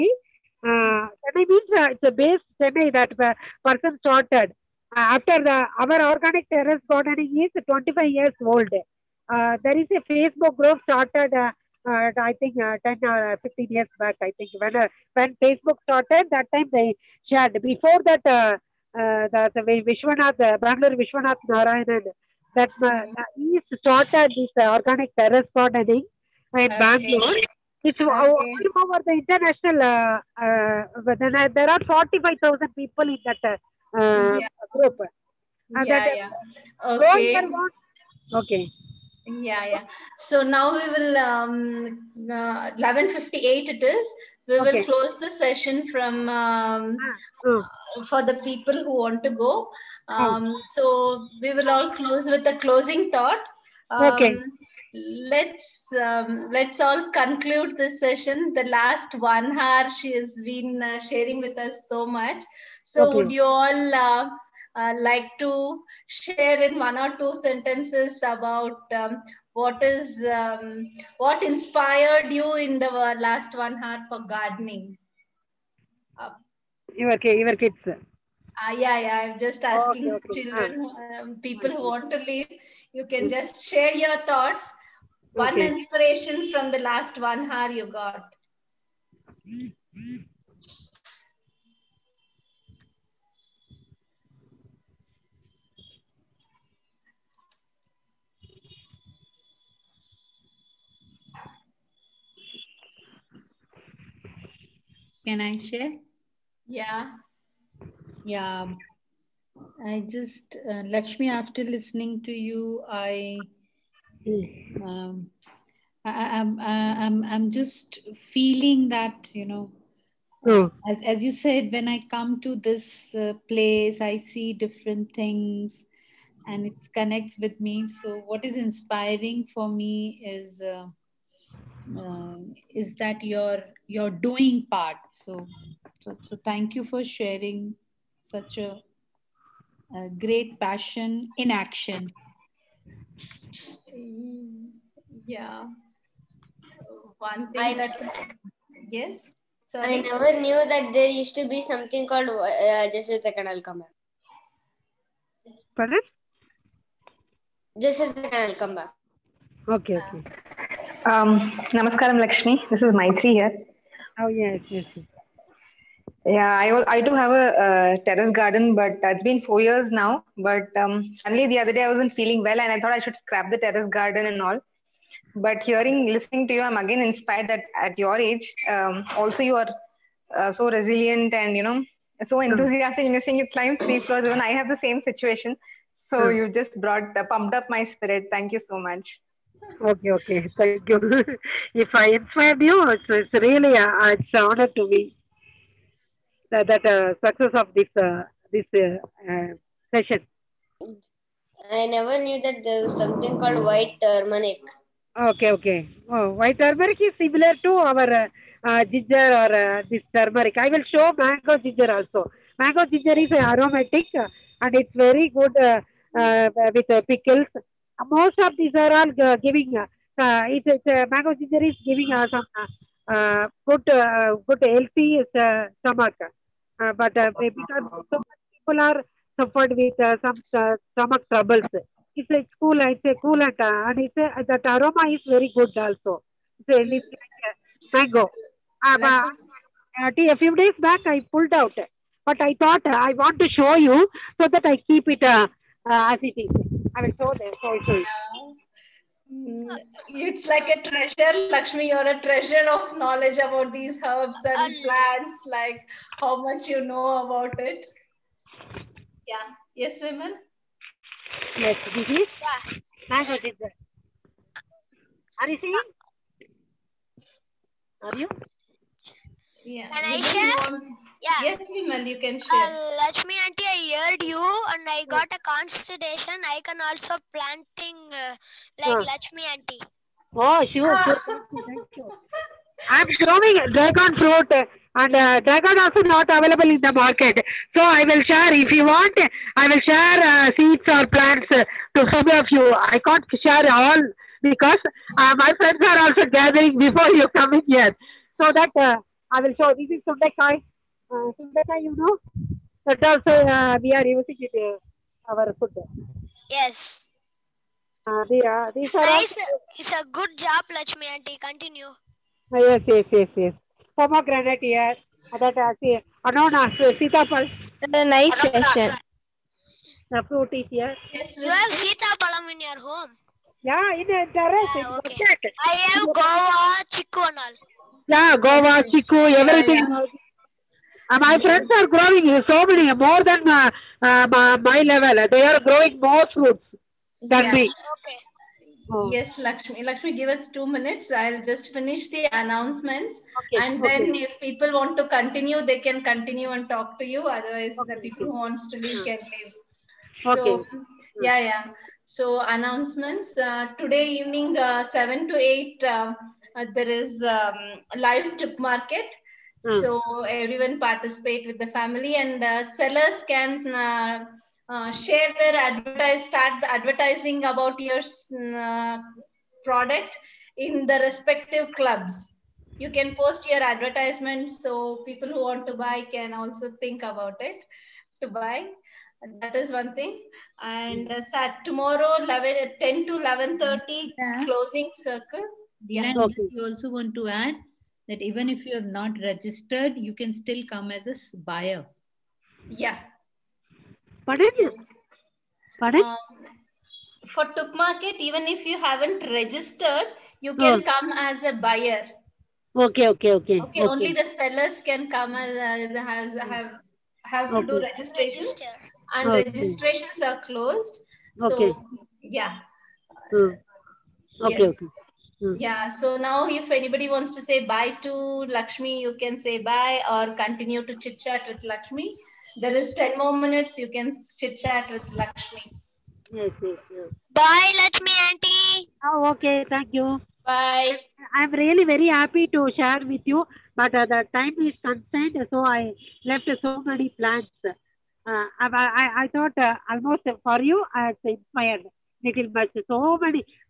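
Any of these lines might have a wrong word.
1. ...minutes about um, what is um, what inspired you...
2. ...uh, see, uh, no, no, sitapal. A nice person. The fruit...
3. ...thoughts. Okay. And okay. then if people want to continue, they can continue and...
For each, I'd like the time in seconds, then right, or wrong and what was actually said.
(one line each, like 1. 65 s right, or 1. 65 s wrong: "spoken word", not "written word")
1. 67 s wrong: "sentences", not "minutes"
2. 315 s wrong: "session", not "person"
3. 342 s wrong: "announcements", not "thoughts".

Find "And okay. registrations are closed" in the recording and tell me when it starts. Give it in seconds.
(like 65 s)
409 s.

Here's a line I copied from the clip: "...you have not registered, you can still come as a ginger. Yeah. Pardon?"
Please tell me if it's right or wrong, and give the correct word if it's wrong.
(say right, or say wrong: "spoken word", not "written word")
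wrong: "buyer", not "ginger".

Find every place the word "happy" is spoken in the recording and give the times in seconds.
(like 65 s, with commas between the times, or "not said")
432 s.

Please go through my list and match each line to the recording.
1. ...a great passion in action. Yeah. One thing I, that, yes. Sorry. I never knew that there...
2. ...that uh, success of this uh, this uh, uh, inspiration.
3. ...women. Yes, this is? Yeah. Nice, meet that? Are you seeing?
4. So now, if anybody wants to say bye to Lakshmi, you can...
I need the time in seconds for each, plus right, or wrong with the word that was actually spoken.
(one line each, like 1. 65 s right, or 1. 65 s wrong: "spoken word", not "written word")
1. 139 s right
2. 196 s wrong: "session", not "inspiration"
3. 260 s right
4. 415 s right.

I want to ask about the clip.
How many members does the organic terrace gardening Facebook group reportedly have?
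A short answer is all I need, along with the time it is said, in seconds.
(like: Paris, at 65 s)
45,000, at 31 s.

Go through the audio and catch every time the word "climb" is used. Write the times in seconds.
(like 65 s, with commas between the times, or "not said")
183 s.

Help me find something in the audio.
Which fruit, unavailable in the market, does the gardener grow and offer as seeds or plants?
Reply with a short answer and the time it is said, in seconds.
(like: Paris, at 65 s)
Dragon fruit, at 283 s.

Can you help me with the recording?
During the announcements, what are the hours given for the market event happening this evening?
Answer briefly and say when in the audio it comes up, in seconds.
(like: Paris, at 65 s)
7 to 8, at 354 s.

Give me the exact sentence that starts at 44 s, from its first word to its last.
will close the session from um, hmm.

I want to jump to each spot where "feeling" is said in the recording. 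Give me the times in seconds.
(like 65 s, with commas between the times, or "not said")
118 s, 172 s.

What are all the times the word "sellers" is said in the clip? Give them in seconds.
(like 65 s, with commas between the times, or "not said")
362 s, 404 s.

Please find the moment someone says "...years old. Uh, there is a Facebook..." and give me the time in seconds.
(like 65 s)
8 s.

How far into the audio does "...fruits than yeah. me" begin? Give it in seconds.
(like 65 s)
336 s.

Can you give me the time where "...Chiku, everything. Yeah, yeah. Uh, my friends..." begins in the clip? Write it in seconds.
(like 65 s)
328 s.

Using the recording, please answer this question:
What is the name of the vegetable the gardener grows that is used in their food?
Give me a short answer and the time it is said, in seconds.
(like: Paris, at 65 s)
Sundakai, at 300 s.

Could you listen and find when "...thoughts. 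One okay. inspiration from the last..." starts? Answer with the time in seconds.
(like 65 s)
84 s.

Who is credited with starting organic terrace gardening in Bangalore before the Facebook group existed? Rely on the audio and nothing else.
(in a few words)
Vishwanath Narayanan.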